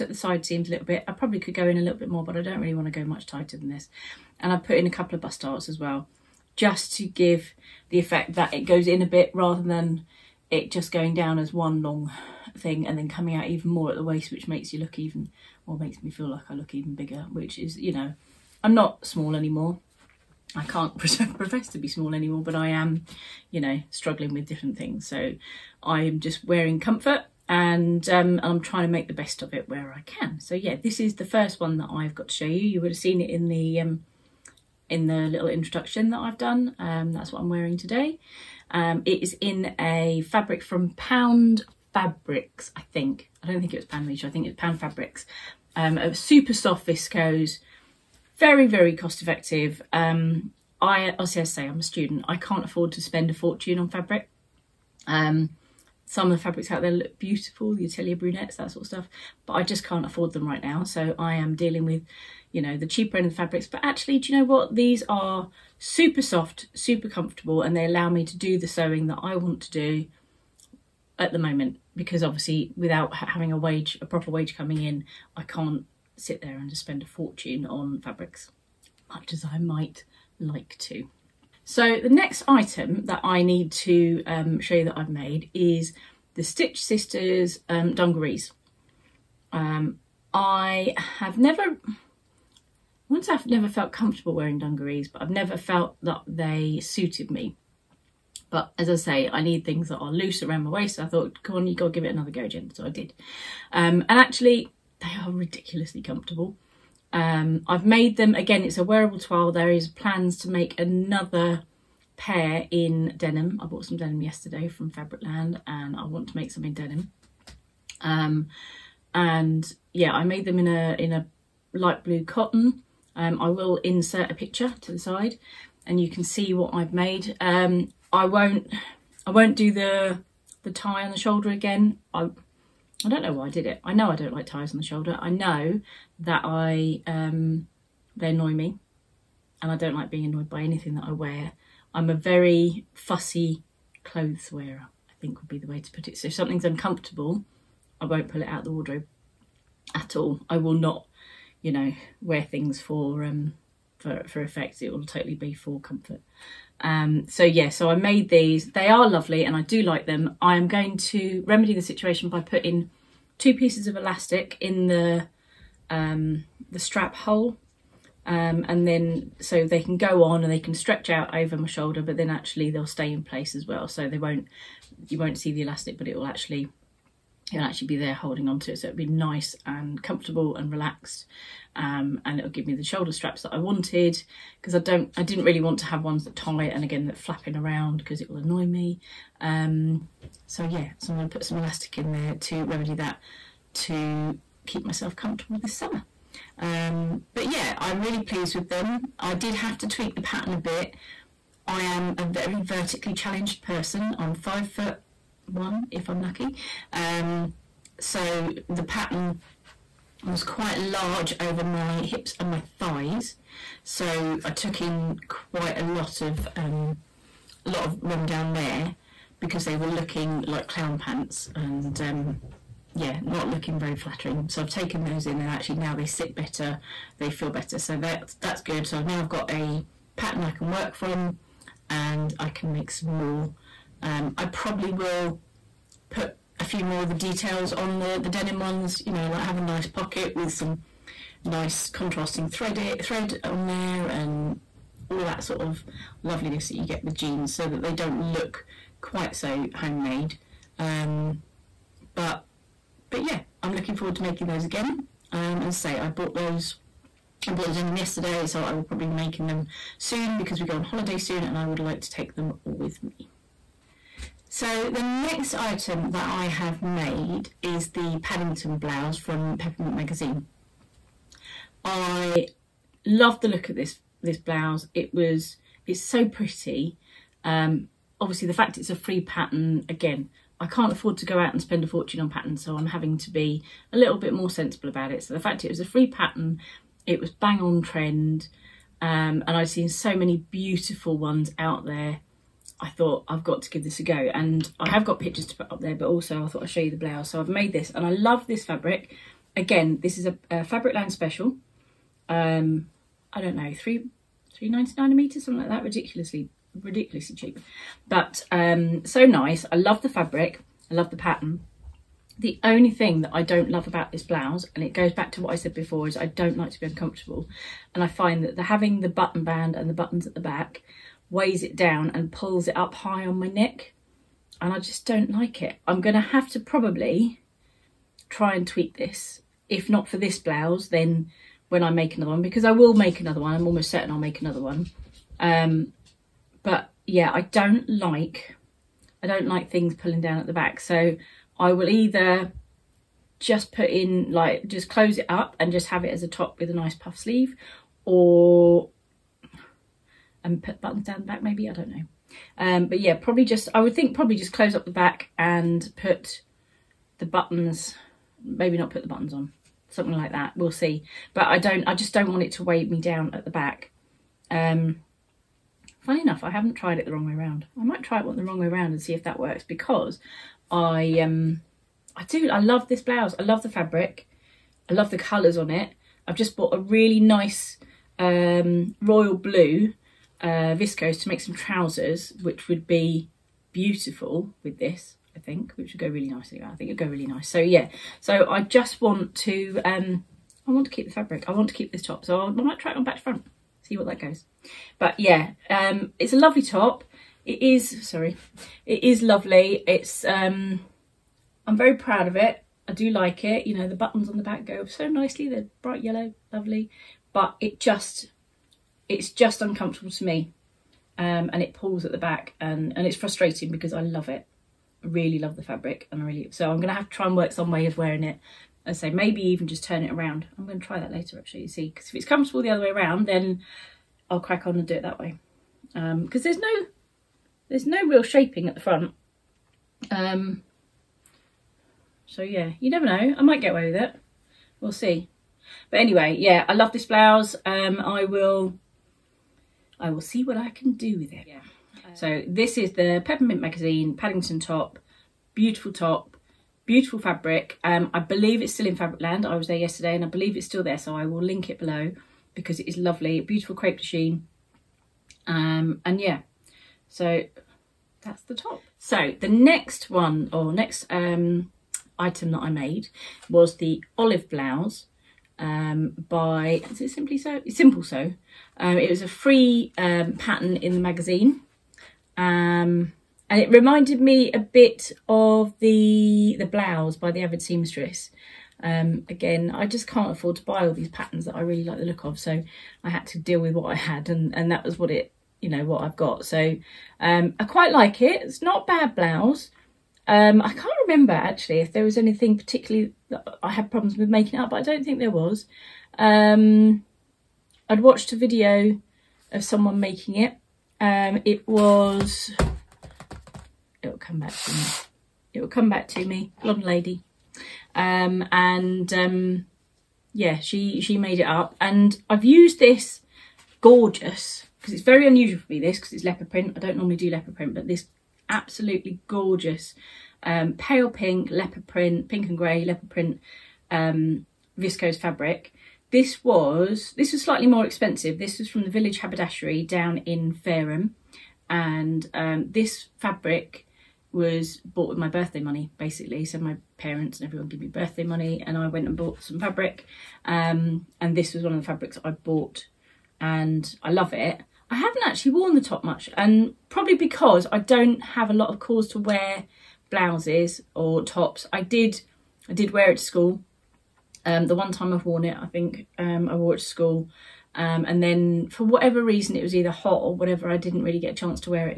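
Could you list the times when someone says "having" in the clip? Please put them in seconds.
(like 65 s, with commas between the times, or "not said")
73 s, 282 s, 318 s.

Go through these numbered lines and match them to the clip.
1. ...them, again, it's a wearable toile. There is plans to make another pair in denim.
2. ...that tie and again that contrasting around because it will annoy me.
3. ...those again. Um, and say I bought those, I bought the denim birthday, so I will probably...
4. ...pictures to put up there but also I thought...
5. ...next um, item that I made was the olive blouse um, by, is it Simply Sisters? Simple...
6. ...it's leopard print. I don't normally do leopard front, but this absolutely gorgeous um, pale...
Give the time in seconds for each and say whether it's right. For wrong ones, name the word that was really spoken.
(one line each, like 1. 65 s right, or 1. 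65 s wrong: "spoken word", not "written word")
1. 108 s right
2. 186 s wrong: "flapping", not "contrasting"
3. 254 s wrong: "yesterday", not "birthday"
4. 295 s right
5. 460 s wrong: "Sew", not "Sisters"
6. 516 s wrong: "print", not "front".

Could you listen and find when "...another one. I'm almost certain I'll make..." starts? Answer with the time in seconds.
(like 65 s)
333 s.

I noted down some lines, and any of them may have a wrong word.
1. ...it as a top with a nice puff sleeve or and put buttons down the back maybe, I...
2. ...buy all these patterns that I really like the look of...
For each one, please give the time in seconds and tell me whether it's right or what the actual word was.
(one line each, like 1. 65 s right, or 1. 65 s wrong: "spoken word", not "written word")
1. 346 s right
2. 480 s right.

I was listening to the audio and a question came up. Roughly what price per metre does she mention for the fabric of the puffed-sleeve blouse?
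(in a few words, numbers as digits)
3.99.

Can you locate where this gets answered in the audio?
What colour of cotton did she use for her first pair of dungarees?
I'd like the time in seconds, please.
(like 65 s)
121 s.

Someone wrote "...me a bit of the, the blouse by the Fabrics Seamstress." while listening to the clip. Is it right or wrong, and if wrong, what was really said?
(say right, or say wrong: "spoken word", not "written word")
wrong: "Avid", not "Fabrics".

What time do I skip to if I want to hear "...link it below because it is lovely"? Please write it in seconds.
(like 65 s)
451 s.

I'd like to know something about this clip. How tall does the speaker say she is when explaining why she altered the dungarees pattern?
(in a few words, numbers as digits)
5 foot 1.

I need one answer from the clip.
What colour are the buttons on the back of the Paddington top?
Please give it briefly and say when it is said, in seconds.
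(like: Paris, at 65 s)
Bright yellow, at 405 s.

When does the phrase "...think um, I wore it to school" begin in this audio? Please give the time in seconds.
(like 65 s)
555 s.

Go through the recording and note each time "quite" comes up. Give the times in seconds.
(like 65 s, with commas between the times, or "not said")
210 s, 215 s, 249 s, 487 s.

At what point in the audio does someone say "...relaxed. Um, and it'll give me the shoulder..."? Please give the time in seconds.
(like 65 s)
180 s.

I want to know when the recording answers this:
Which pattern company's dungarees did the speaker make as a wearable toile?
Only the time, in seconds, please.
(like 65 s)
86 s.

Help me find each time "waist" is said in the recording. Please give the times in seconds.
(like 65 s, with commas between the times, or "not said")
14 s, 100 s.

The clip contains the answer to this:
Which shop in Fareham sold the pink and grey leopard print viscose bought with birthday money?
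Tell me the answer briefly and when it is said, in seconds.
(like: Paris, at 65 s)
Village Haberdashery, at 528 s.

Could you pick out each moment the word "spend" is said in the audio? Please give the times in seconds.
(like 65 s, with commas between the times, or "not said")
52 s, 76 s, 281 s.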